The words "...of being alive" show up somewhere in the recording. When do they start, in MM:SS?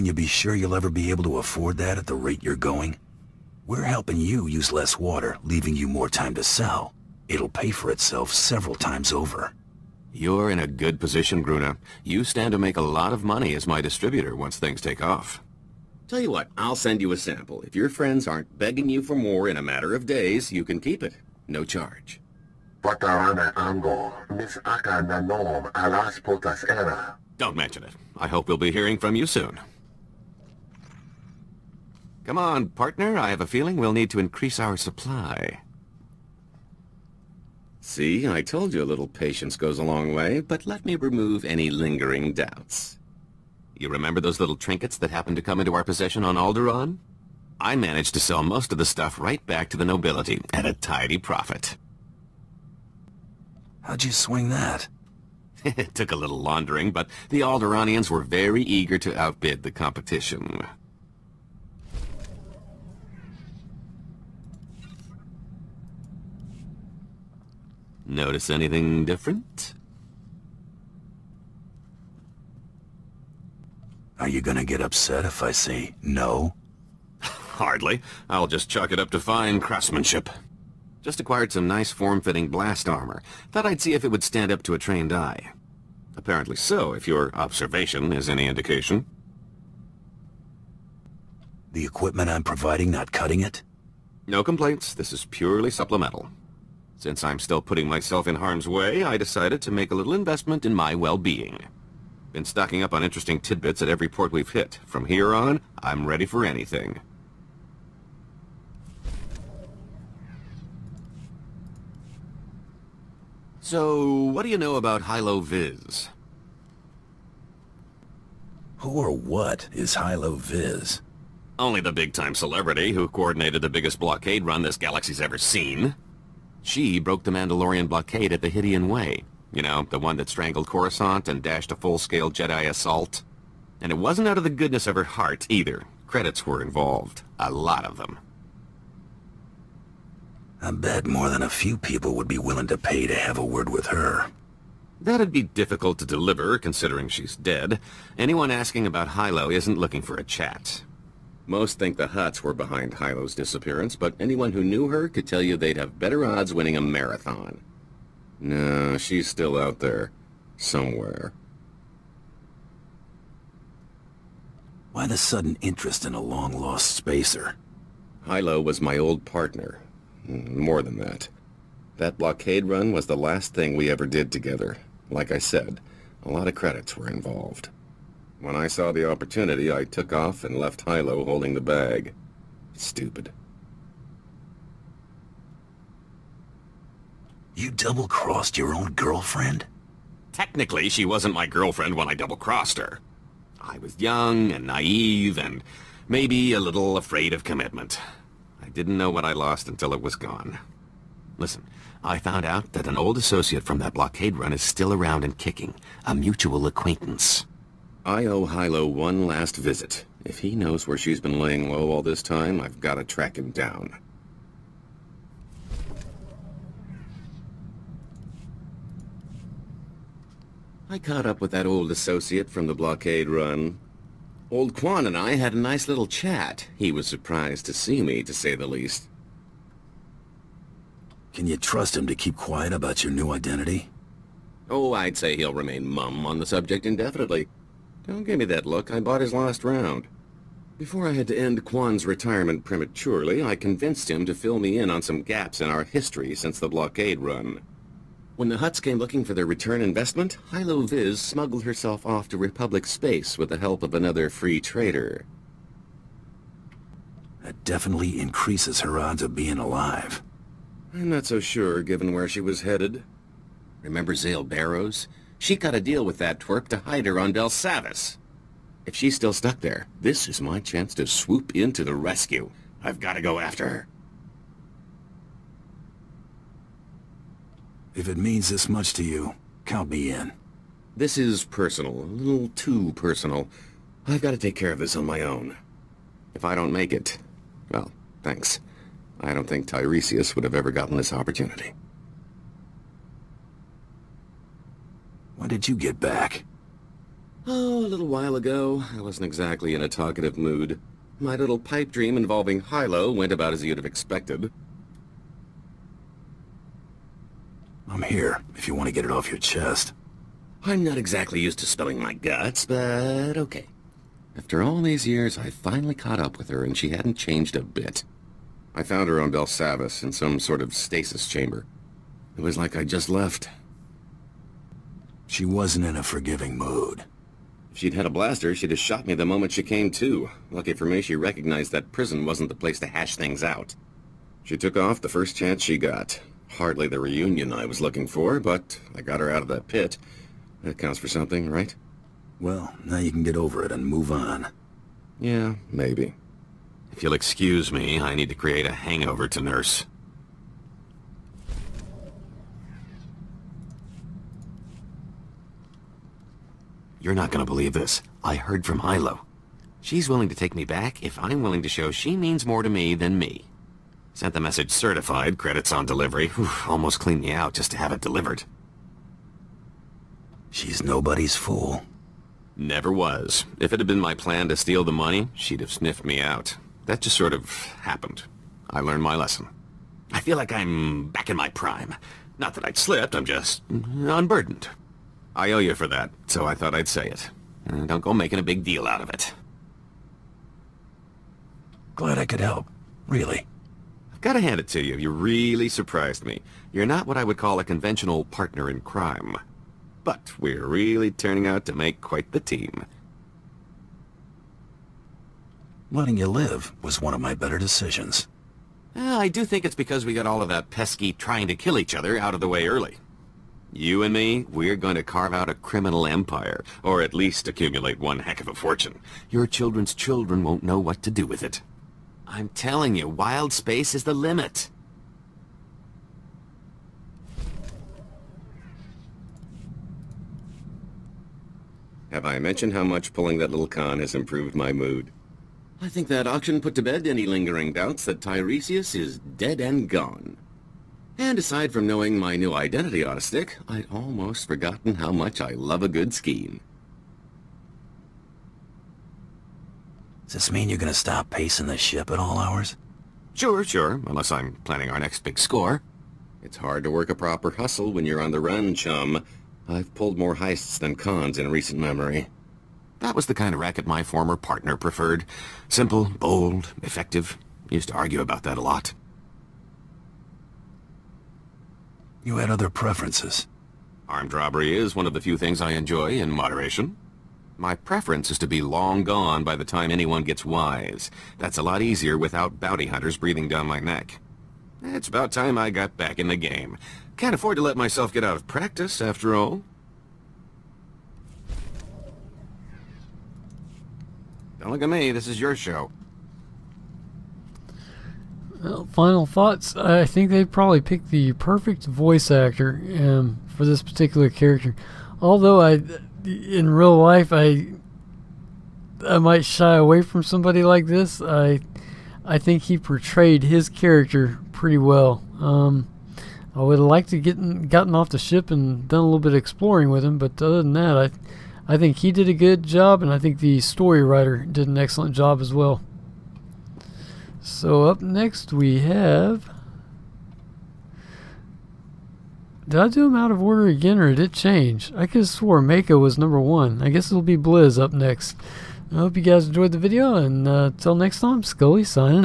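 04:19.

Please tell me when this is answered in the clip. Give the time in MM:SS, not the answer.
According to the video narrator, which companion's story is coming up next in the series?
08:57.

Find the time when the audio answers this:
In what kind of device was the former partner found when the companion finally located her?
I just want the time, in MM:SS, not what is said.
05:20.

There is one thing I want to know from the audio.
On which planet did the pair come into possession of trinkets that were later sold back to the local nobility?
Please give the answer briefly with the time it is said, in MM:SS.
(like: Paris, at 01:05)
Alderaan, at 00:46.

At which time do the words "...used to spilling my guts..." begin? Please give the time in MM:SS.
05:11.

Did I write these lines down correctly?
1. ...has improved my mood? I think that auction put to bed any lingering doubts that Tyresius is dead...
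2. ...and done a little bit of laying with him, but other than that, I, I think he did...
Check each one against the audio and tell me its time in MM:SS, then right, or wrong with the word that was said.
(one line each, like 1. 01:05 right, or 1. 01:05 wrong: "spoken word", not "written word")
1. 07:13 right
2. 08:38 wrong: "exploring", not "laying".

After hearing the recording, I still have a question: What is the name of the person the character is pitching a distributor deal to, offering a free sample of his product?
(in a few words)
Gruna.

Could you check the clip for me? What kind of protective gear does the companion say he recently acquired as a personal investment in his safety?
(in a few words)
blast armor.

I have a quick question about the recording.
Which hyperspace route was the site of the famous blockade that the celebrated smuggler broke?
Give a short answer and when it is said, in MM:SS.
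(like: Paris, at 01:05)
Hydian Way, at 02:08.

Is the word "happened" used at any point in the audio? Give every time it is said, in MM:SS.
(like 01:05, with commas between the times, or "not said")
00:45, 06:17.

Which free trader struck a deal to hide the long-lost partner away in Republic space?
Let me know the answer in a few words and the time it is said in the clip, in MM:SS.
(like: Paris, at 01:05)
Zale Barrows, at 04:24.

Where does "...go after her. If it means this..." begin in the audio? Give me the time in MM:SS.
04:33.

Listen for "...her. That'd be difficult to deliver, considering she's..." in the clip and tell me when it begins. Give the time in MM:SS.
02:23.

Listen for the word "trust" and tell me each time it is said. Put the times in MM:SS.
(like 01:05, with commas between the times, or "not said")
03:51.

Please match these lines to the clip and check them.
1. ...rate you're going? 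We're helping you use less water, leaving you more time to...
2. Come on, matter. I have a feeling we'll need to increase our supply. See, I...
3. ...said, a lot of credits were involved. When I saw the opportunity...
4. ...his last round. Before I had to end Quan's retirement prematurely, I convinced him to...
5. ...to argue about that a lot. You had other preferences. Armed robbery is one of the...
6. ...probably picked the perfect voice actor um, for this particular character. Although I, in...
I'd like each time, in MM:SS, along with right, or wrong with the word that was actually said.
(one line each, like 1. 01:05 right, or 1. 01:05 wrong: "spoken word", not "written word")
1. 00:02 right
2. 00:32 wrong: "partner", not "matter"
3. 02:55 right
4. 03:59 right
5. 07:47 right
6. 08:20 right.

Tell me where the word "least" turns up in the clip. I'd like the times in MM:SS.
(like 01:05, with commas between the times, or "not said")
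03:48, 06:57.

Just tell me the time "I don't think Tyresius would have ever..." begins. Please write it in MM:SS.
04:49.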